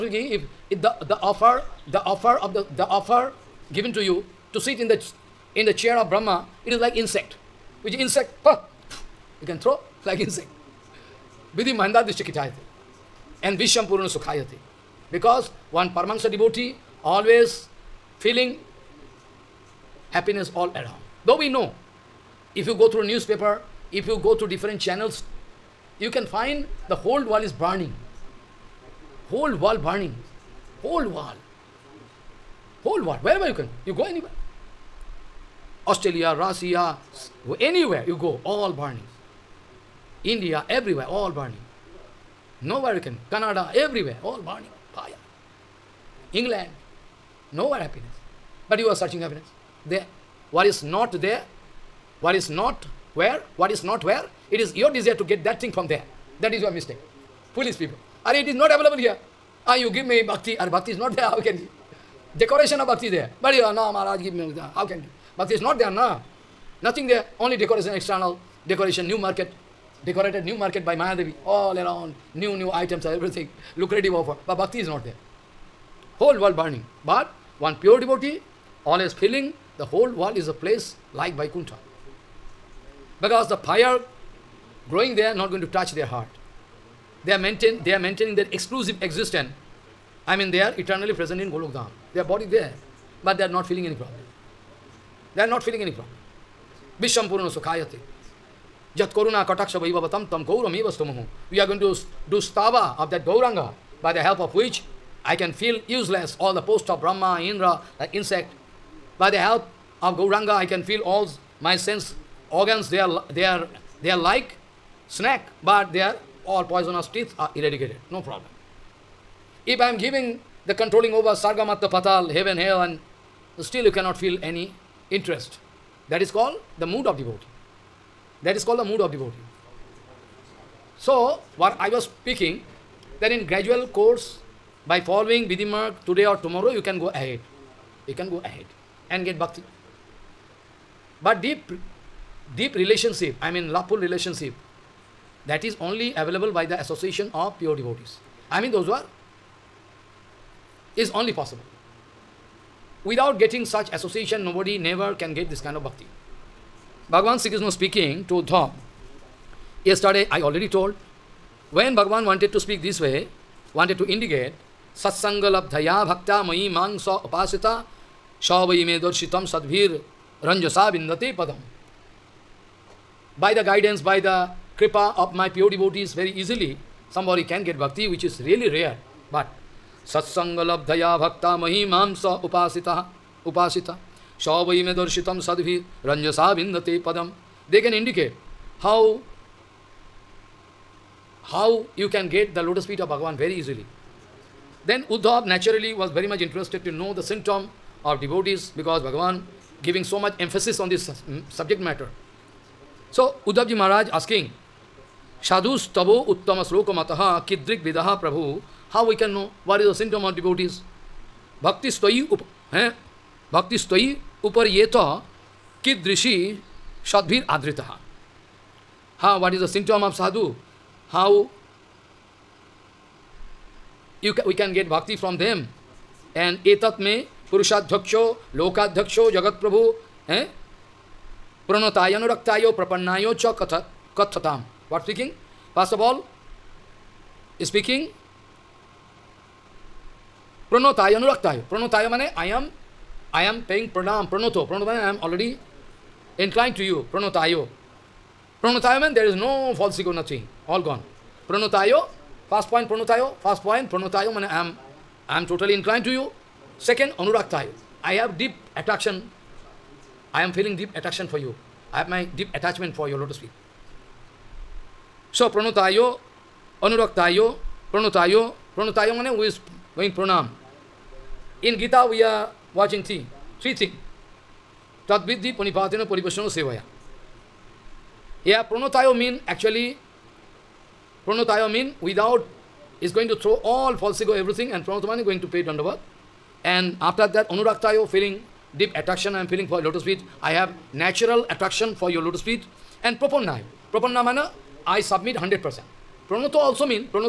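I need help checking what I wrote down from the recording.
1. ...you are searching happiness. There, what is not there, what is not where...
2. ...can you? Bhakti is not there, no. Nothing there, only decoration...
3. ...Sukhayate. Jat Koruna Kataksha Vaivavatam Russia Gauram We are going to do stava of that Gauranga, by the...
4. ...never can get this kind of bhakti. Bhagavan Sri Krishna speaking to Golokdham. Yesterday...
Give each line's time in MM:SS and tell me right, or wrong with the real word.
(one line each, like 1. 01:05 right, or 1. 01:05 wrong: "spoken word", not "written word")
1. 00:48 right
2. 01:04 right
3. 01:37 wrong: "Tam", not "Russia"
4. 02:34 wrong: "Dharm", not "Golokdham".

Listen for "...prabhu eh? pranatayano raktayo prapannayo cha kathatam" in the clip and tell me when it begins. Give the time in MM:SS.
03:49.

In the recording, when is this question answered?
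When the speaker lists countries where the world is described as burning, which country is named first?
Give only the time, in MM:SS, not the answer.
00:35.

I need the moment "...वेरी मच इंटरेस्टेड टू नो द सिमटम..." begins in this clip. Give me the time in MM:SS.
03:16.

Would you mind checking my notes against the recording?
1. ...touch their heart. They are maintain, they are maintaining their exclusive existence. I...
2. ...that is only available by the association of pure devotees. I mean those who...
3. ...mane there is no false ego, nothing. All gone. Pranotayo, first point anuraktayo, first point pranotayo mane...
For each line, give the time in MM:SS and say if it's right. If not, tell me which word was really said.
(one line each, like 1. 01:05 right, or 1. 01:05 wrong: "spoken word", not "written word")
1. 01:25 right
2. 02:25 right
3. 04:08 wrong: "pranotayo", not "anuraktayo".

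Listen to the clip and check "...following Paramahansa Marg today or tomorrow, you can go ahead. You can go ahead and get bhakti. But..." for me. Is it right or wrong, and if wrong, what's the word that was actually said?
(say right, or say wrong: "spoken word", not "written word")
wrong: "Vidhi", not "Paramahansa".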